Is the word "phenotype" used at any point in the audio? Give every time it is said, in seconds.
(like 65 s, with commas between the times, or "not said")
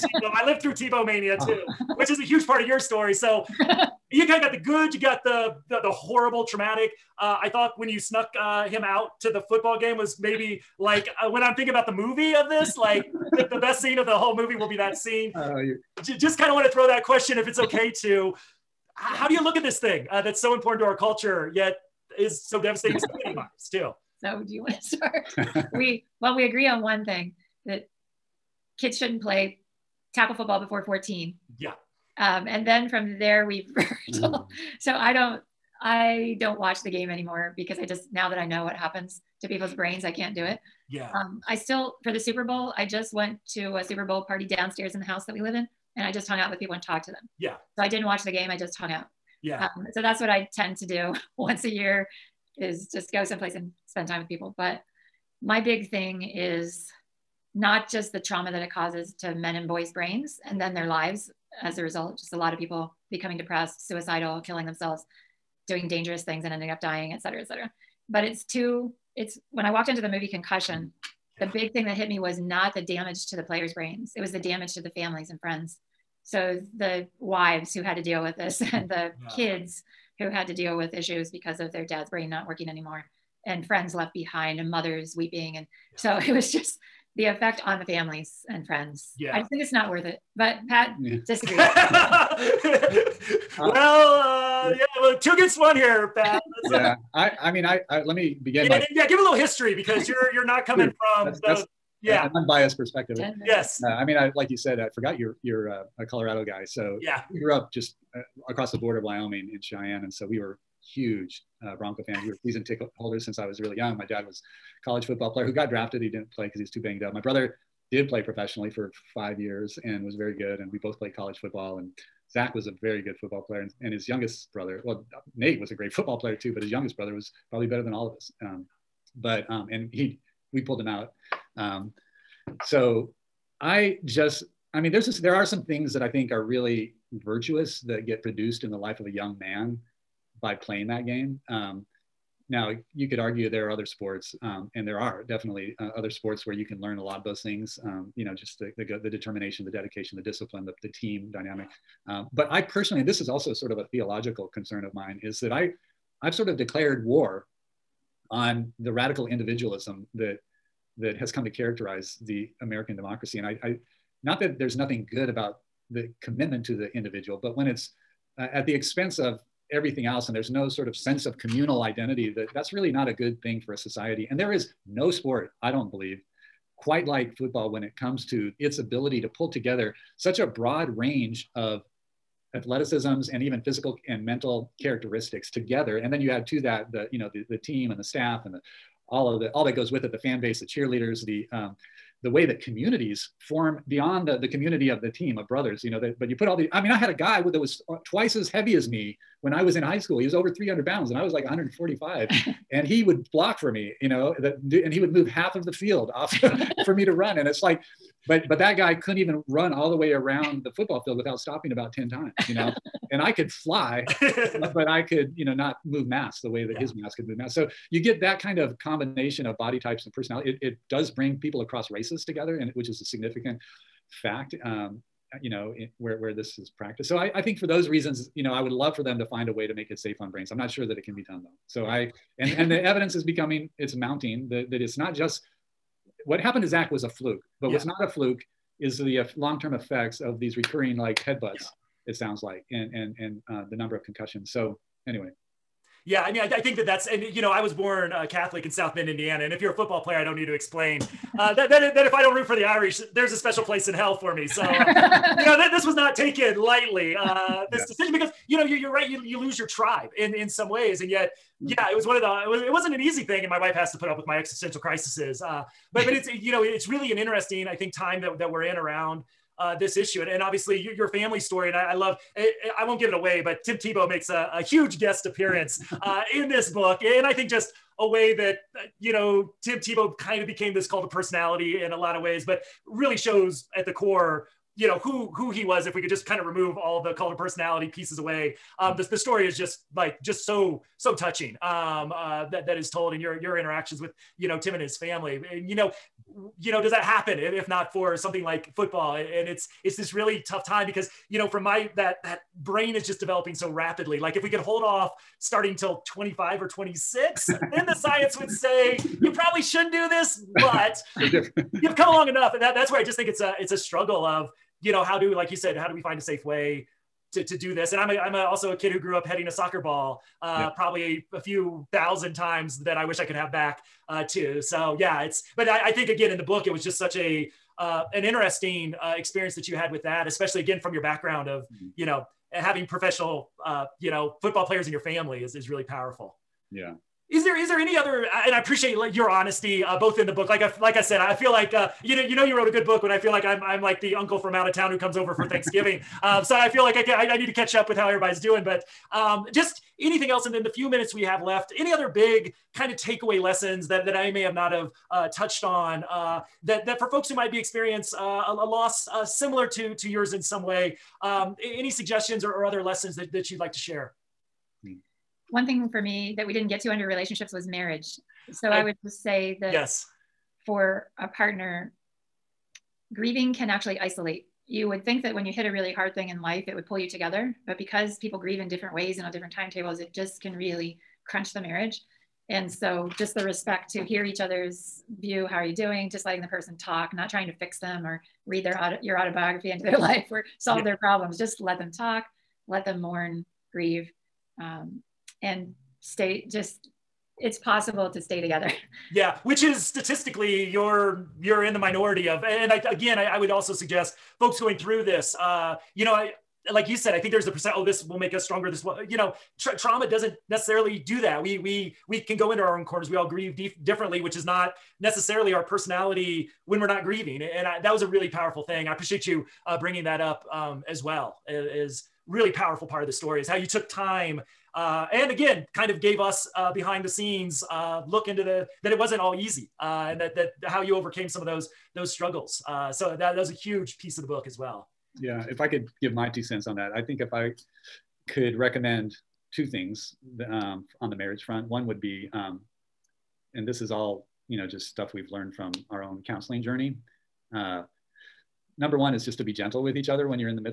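not said.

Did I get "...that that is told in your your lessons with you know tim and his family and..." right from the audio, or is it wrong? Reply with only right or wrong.
wrong.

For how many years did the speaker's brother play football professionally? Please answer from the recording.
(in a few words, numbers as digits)
5.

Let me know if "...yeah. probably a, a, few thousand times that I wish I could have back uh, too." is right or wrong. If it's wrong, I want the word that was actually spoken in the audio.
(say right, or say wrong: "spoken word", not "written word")
right.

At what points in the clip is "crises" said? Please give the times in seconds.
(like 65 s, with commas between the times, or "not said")
264 s.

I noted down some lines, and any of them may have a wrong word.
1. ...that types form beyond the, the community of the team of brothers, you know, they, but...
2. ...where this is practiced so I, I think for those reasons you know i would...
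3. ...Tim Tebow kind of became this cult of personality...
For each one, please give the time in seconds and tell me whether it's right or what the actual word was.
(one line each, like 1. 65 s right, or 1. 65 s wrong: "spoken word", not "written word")
1. 192 s wrong: "communities", not "types"
2. 226 s right
3. 279 s right.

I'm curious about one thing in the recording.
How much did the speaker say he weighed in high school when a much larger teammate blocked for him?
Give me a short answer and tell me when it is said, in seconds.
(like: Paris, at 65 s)
145, at 201 s.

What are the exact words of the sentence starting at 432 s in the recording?
Uh, so that, that was a huge piece of the book as well.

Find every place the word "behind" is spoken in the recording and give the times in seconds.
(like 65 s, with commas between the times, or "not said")
84 s, 426 s.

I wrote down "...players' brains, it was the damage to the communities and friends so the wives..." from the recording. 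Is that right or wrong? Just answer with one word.
wrong.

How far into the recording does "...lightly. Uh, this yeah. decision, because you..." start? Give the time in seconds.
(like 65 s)
256 s.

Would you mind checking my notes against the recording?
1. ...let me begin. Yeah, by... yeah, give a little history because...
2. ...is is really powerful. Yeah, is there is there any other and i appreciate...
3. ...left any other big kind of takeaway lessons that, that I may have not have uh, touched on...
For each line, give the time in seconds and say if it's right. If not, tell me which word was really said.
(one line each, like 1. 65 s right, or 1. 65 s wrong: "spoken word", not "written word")
1. 98 s right
2. 335 s right
3. 351 s right.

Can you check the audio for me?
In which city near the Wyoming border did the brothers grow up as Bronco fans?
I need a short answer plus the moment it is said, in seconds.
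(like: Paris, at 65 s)
Cheyenne, at 109 s.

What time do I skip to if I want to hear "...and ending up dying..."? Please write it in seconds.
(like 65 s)
66 s.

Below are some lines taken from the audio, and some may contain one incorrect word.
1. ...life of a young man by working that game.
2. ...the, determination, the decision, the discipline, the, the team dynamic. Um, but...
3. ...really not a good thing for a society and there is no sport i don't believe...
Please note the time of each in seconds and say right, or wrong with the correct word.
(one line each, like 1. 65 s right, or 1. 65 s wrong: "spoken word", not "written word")
1. 138 s wrong: "playing", not "working"
2. 149 s wrong: "dedication", not "decision"
3. 172 s right.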